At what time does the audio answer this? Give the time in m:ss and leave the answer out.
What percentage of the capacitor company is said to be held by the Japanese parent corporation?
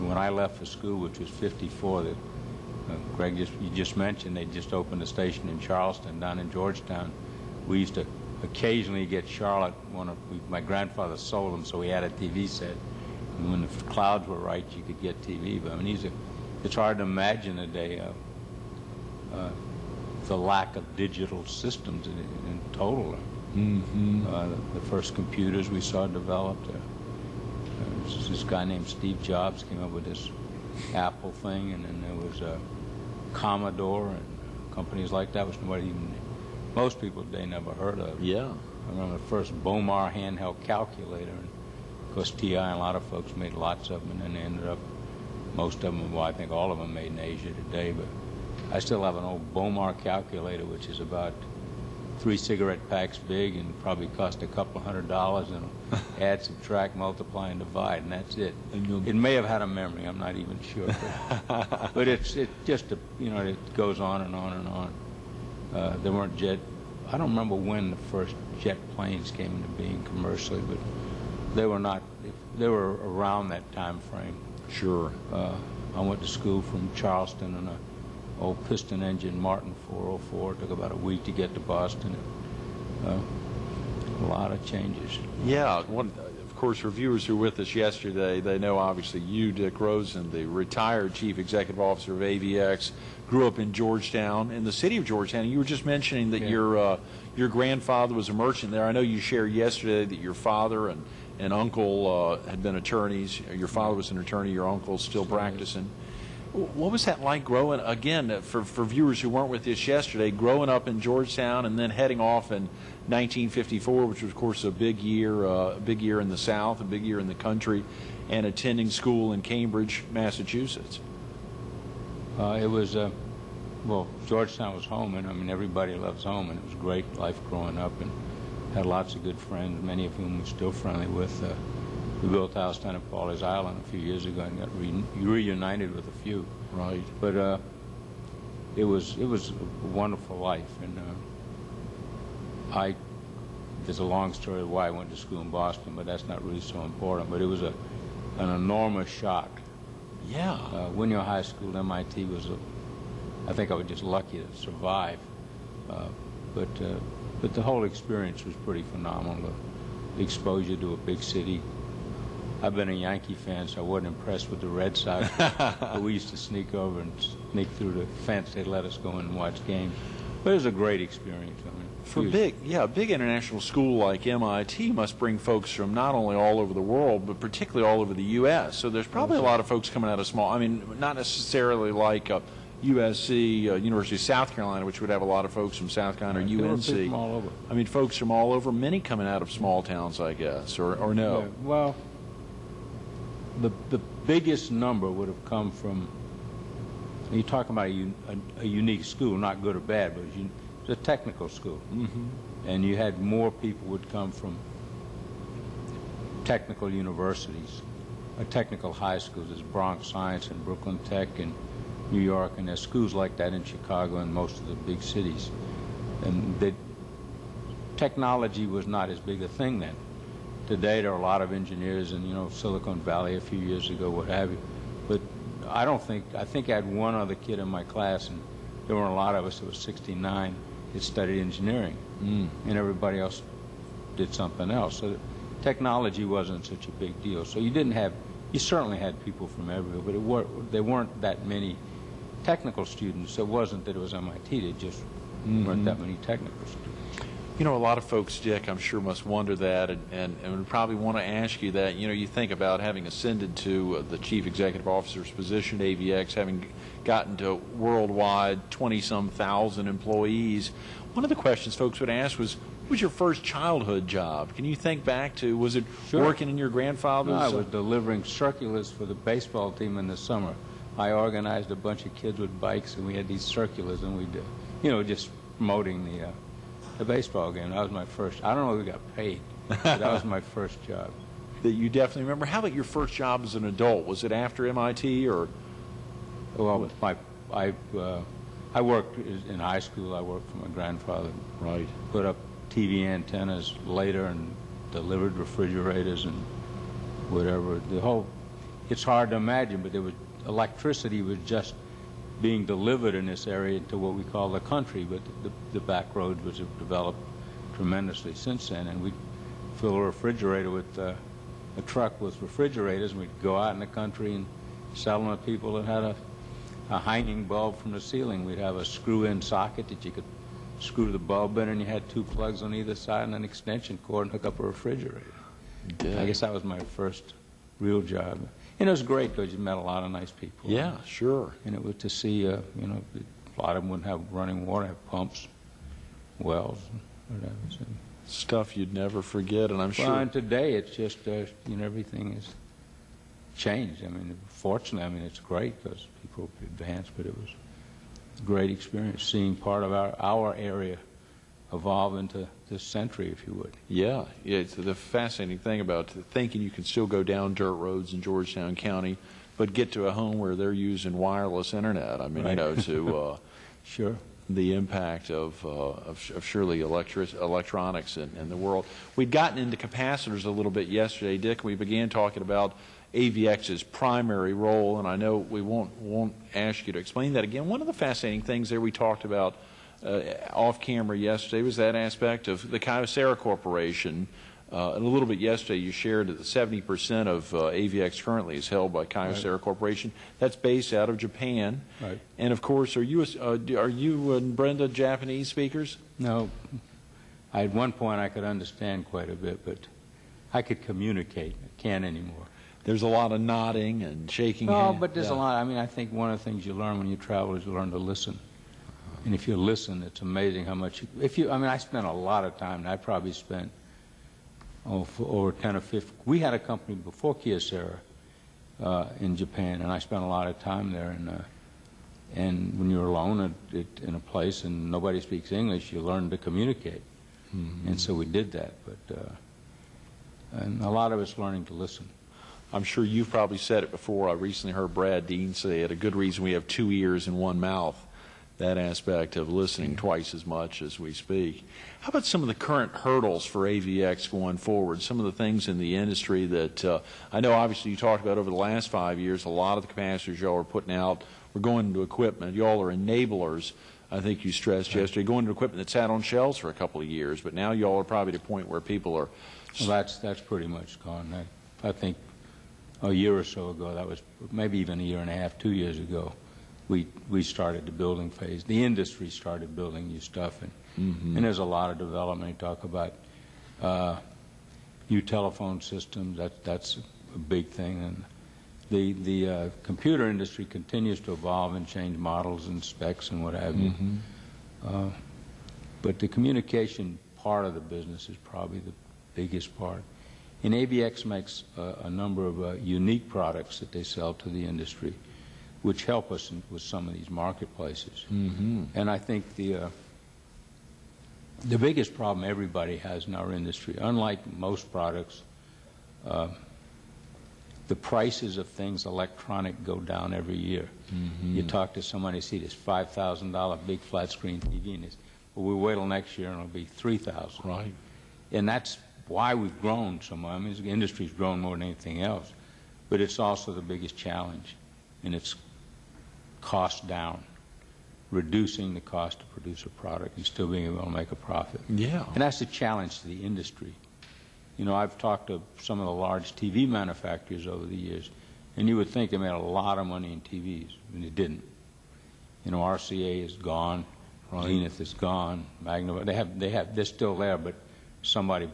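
6:26.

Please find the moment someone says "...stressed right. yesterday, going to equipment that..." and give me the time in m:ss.
7:34.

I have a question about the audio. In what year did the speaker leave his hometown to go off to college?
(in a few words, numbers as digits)
1954.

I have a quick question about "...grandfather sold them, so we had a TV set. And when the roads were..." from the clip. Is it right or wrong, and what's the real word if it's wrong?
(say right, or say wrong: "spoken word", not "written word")
wrong: "clouds", not "roads".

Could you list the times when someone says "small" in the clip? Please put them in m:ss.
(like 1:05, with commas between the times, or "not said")
3:00, 3:09.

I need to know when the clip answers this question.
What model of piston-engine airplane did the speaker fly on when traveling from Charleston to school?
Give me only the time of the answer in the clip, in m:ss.
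1:19.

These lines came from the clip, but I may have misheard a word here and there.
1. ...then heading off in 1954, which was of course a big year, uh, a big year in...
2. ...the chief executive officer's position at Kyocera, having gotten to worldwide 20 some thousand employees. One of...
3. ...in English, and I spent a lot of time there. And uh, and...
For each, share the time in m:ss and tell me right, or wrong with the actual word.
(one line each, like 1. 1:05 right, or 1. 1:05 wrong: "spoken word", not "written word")
1. 1:51 right
2. 4:14 wrong: "AVX", not "Kyocera"
3. 6:59 wrong: "Japan", not "English".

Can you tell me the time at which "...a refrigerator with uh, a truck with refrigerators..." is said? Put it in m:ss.
5:09.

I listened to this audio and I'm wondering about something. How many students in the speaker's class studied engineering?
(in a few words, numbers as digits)
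69.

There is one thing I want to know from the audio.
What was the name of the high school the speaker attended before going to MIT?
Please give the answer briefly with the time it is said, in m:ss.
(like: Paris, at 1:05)
Winyah High School, at 2:30.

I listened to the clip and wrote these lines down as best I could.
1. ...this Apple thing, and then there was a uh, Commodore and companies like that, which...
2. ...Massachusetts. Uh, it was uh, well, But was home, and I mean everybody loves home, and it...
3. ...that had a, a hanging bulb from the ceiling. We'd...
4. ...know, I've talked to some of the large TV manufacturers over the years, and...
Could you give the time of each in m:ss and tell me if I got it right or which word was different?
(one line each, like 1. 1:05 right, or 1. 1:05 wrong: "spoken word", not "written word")
1. 0:30 right
2. 2:00 wrong: "Georgetown", not "But"
3. 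5:15 right
4. 8:54 right.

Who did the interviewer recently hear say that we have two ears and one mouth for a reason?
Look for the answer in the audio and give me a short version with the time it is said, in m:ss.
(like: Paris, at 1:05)
Brad Dean, at 7:14.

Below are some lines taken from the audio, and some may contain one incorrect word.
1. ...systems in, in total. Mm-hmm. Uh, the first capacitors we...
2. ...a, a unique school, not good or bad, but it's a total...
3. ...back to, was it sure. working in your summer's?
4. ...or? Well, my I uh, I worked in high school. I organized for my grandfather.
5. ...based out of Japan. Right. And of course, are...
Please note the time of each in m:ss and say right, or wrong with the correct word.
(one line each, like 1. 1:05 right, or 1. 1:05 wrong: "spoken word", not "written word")
1. 0:21 wrong: "computers", not "capacitors"
2. 3:18 wrong: "technical", not "total"
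3. 4:25 wrong: "grandfather", not "summer"
4. 4:45 wrong: "worked", not "organized"
5. 6:30 right.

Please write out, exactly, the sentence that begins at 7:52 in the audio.
You talk about uh, new telephone systems.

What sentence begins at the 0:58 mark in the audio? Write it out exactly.
And it may have had a memory, I'm not even sure.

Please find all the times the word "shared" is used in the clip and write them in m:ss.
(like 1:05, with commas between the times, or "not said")
1:39, 6:25.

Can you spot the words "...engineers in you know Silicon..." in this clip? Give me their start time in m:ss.
3:41.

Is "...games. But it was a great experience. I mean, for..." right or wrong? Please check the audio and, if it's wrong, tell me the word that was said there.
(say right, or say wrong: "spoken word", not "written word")
right.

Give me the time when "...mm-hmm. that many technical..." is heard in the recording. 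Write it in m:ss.
4:05.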